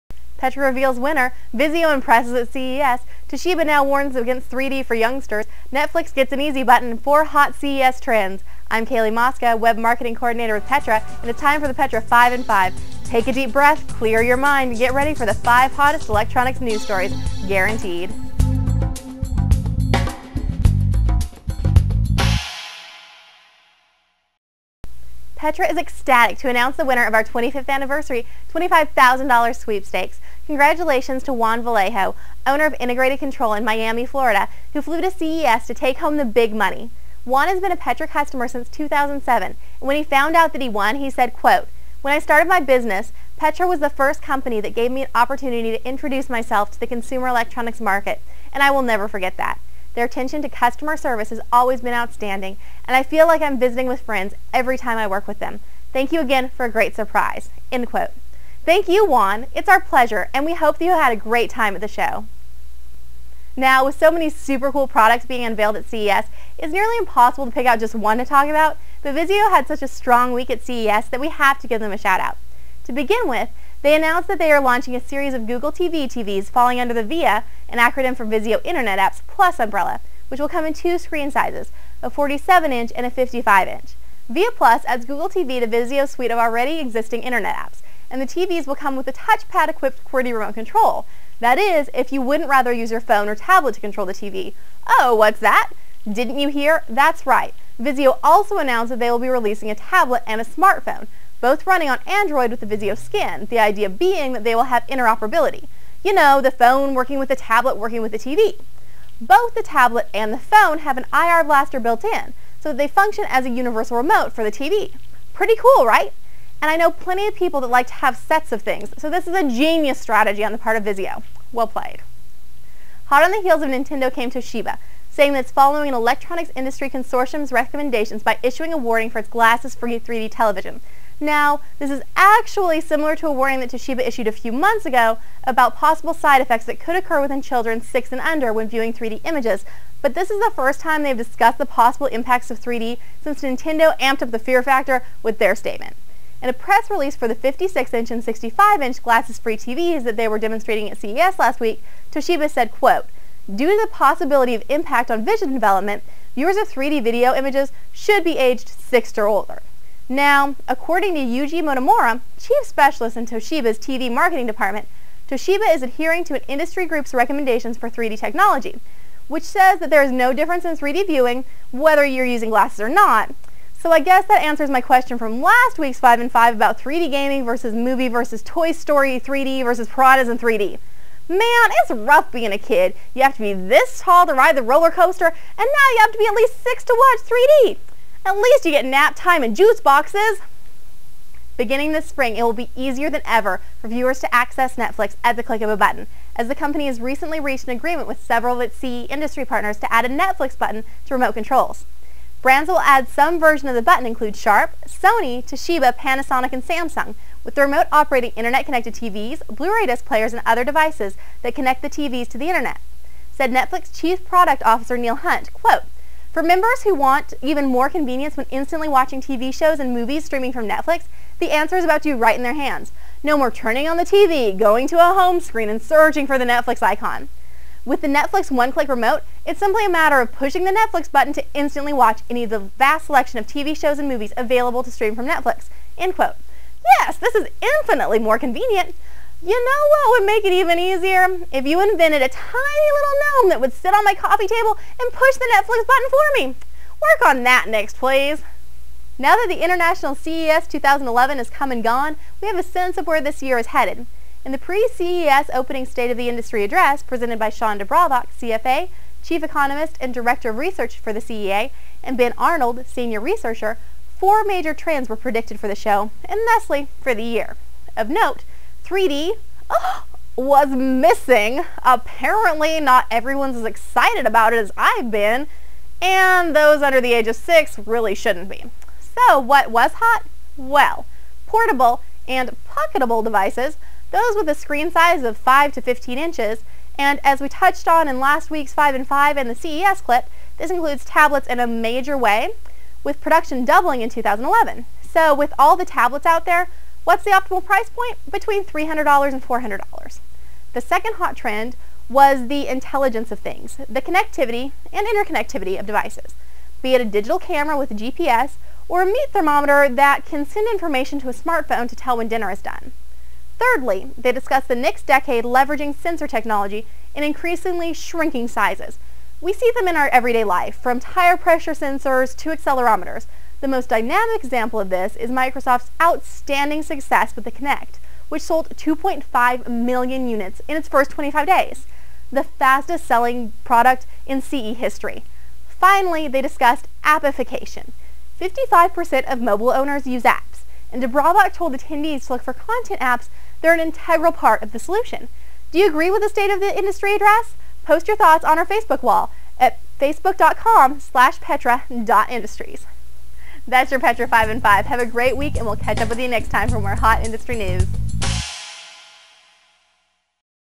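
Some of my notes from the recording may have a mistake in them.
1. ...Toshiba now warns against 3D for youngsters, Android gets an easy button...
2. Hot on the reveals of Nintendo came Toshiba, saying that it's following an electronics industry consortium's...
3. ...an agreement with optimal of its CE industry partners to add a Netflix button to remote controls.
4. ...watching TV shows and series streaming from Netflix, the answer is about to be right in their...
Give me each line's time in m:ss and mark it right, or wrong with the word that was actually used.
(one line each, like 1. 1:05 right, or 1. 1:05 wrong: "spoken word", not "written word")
1. 0:03 wrong: "Netflix", not "Android"
2. 2:03 wrong: "heels", not "reveals"
3. 3:17 wrong: "several", not "optimal"
4. 3:38 wrong: "movies", not "series".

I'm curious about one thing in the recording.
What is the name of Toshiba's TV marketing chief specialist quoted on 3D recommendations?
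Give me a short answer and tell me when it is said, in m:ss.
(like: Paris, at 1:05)
Yuji Motomura, at 2:41.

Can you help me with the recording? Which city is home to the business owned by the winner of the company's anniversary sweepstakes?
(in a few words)
Miami.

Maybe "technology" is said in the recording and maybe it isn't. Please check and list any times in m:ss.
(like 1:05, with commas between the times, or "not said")
2:48, 5:16.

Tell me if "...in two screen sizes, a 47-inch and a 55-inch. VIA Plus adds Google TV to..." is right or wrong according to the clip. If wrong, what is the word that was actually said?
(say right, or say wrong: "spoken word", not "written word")
right.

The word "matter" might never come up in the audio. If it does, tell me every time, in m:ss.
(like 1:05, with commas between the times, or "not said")
3:49.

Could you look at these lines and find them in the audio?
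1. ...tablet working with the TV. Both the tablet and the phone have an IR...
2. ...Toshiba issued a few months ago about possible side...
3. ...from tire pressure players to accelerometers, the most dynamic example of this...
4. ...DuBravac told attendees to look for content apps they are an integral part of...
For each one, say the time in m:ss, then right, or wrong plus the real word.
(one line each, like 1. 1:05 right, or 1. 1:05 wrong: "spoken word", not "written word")
1. 1:47 right
2. 2:13 right
3. 5:20 wrong: "sensors", not "players"
4. 5:41 right.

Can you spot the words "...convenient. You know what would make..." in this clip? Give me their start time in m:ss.
3:58.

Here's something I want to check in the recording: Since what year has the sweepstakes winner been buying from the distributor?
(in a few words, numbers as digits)
2007.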